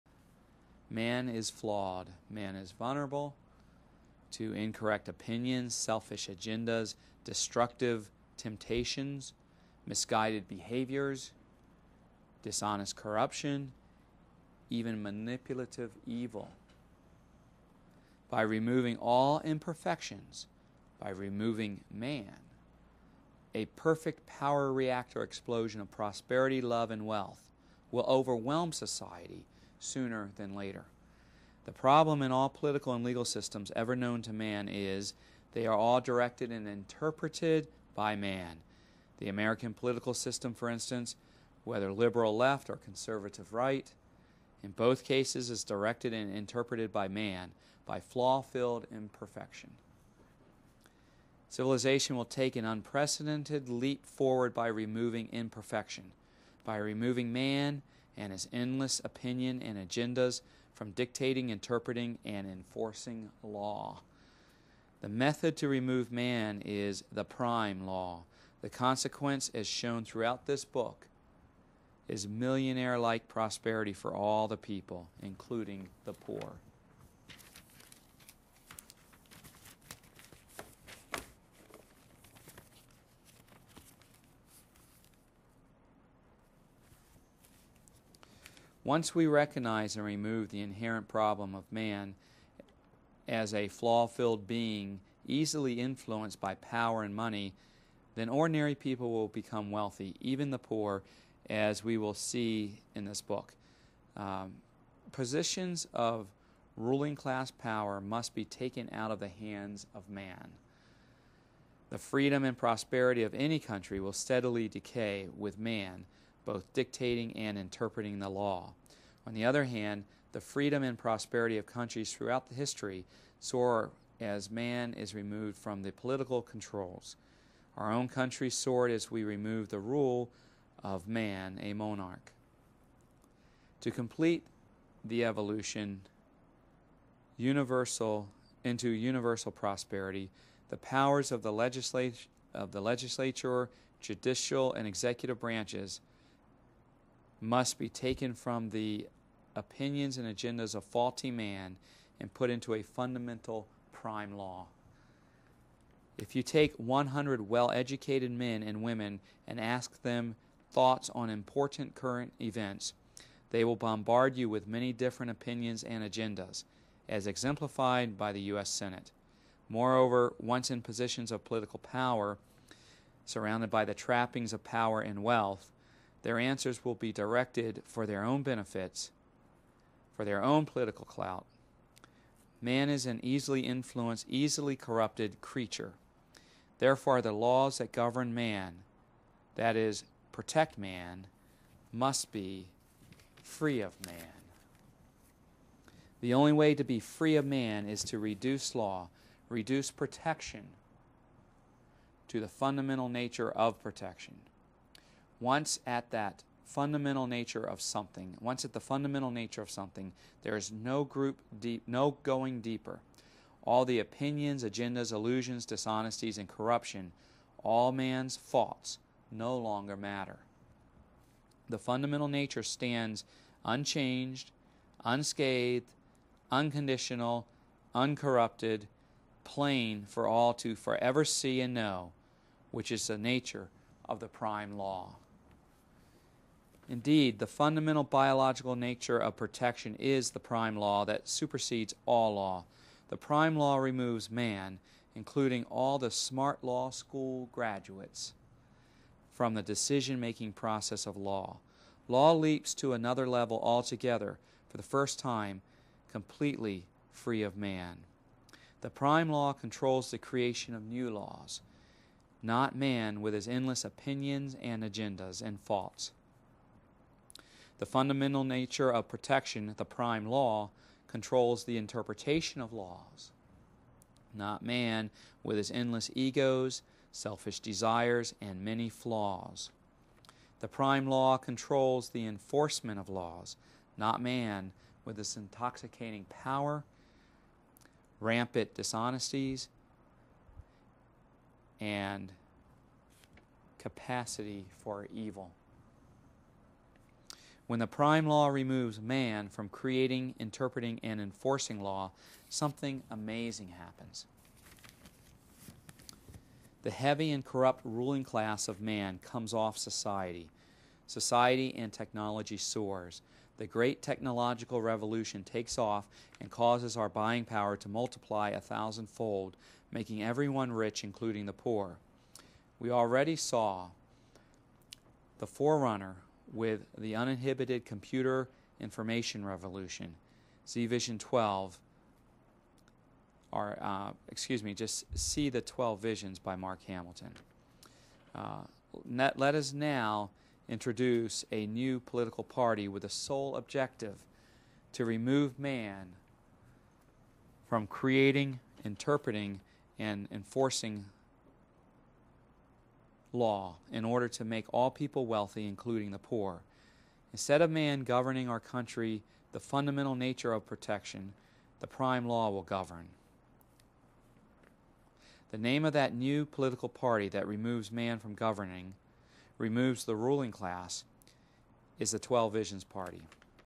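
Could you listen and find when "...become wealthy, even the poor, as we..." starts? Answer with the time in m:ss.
1:39.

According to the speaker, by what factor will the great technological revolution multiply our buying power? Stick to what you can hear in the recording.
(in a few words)
a thousandfold.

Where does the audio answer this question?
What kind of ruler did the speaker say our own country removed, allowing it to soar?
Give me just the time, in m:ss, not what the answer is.
2:11.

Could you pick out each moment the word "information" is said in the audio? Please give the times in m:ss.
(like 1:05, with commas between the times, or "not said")
5:28.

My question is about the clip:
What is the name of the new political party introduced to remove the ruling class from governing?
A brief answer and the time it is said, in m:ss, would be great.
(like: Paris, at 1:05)
12 Visions Party, at 6:12.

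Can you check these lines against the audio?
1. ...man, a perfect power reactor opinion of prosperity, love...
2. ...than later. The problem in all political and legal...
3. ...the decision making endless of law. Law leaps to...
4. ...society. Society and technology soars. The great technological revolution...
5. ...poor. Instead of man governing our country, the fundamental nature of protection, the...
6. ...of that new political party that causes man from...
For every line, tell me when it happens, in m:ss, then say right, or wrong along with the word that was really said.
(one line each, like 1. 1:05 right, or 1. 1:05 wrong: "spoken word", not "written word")
1. 0:21 wrong: "explosion", not "opinion"
2. 0:30 right
3. 4:09 wrong: "process", not "endless"
4. 5:09 right
5. 5:56 right
6. 6:05 wrong: "removes", not "causes".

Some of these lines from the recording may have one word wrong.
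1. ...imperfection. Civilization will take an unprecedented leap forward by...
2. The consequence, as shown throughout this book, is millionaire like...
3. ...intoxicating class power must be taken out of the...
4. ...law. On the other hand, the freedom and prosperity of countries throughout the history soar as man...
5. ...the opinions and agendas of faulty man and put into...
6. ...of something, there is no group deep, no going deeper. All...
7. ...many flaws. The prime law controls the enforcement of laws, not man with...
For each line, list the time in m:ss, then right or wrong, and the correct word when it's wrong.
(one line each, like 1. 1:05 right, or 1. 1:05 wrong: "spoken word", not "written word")
1. 0:48 right
2. 1:08 right
3. 1:46 wrong: "ruling", not "intoxicating"
4. 1:58 right
5. 2:28 right
6. 3:29 right
7. 4:38 right.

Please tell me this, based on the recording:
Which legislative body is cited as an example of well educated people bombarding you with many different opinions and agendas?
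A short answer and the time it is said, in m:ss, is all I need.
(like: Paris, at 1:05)
U.S. Senate, at 2:48.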